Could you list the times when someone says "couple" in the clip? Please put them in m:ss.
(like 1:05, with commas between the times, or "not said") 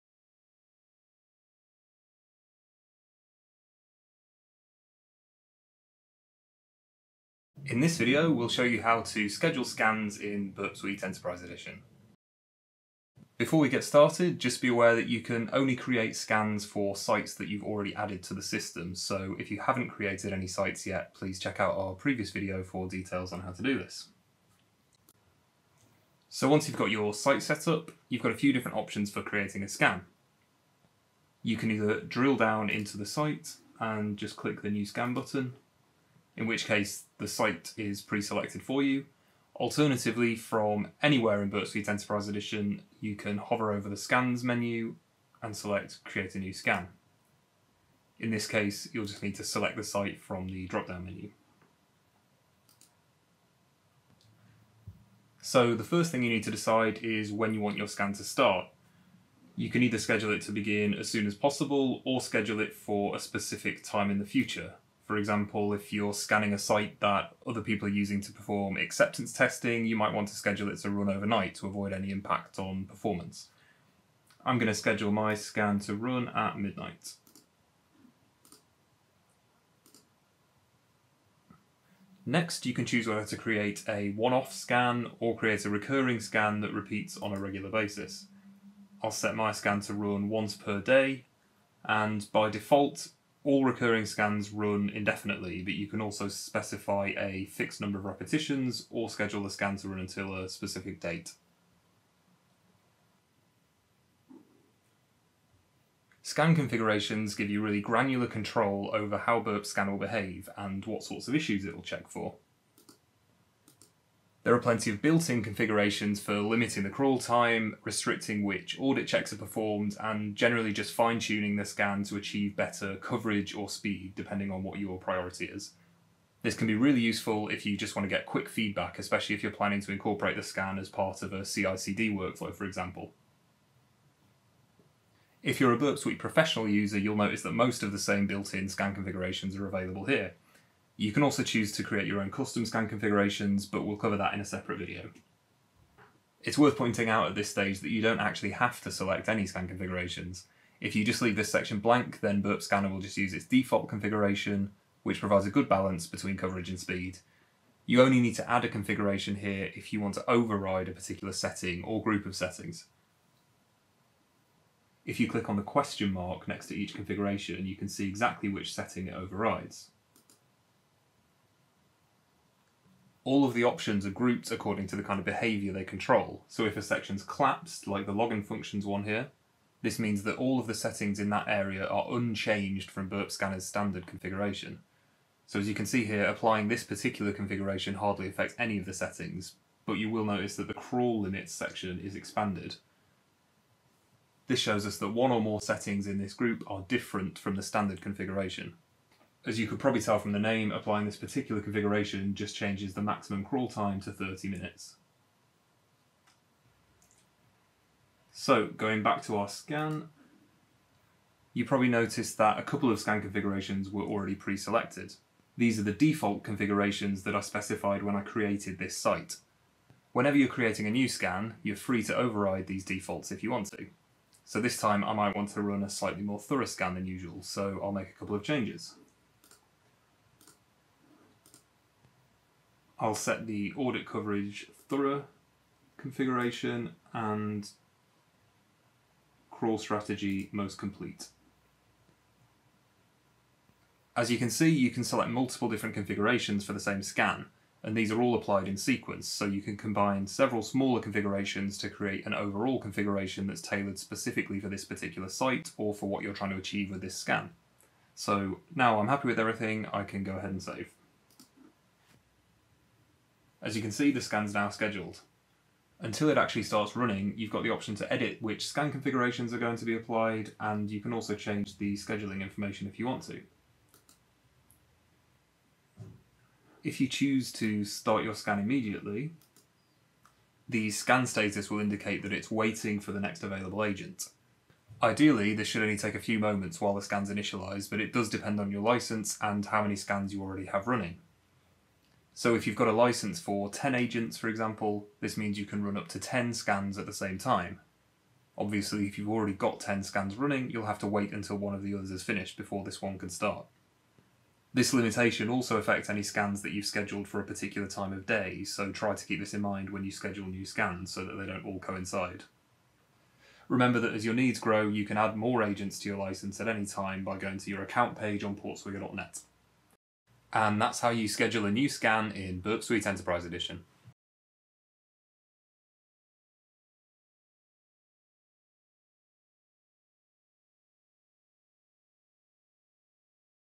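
3:32, 3:48.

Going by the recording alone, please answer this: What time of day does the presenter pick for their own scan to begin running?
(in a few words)
Midnight.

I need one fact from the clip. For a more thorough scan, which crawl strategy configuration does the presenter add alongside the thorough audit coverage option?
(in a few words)
Most complete.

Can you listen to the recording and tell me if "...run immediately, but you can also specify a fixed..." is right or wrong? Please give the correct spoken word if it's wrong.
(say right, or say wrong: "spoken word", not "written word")
wrong: "indefinitely", not "immediately".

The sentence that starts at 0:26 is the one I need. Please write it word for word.
So once you've got your site set up, you've got a few different options for creating a scan.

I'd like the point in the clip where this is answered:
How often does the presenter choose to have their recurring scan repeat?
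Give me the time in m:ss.
1:30.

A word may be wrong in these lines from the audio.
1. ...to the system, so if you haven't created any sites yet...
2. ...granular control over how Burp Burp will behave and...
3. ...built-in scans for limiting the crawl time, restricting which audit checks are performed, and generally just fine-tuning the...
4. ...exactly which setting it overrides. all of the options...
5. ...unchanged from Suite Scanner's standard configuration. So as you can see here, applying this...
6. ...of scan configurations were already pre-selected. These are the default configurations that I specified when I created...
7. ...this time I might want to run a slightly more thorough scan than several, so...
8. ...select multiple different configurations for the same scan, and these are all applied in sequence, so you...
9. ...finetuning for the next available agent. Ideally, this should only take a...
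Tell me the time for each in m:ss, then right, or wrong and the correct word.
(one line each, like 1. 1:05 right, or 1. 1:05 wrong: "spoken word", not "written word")
1. 0:18 right
2. 1:47 wrong: "Scan", not "Burp"
3. 1:55 wrong: "configurations", not "scans"
4. 2:48 right
5. 3:02 wrong: "Burp", not "Suite"
6. 3:32 right
7. 3:44 wrong: "usual", not "several"
8. 4:05 right
9. 4:42 wrong: "waiting", not "finetuning".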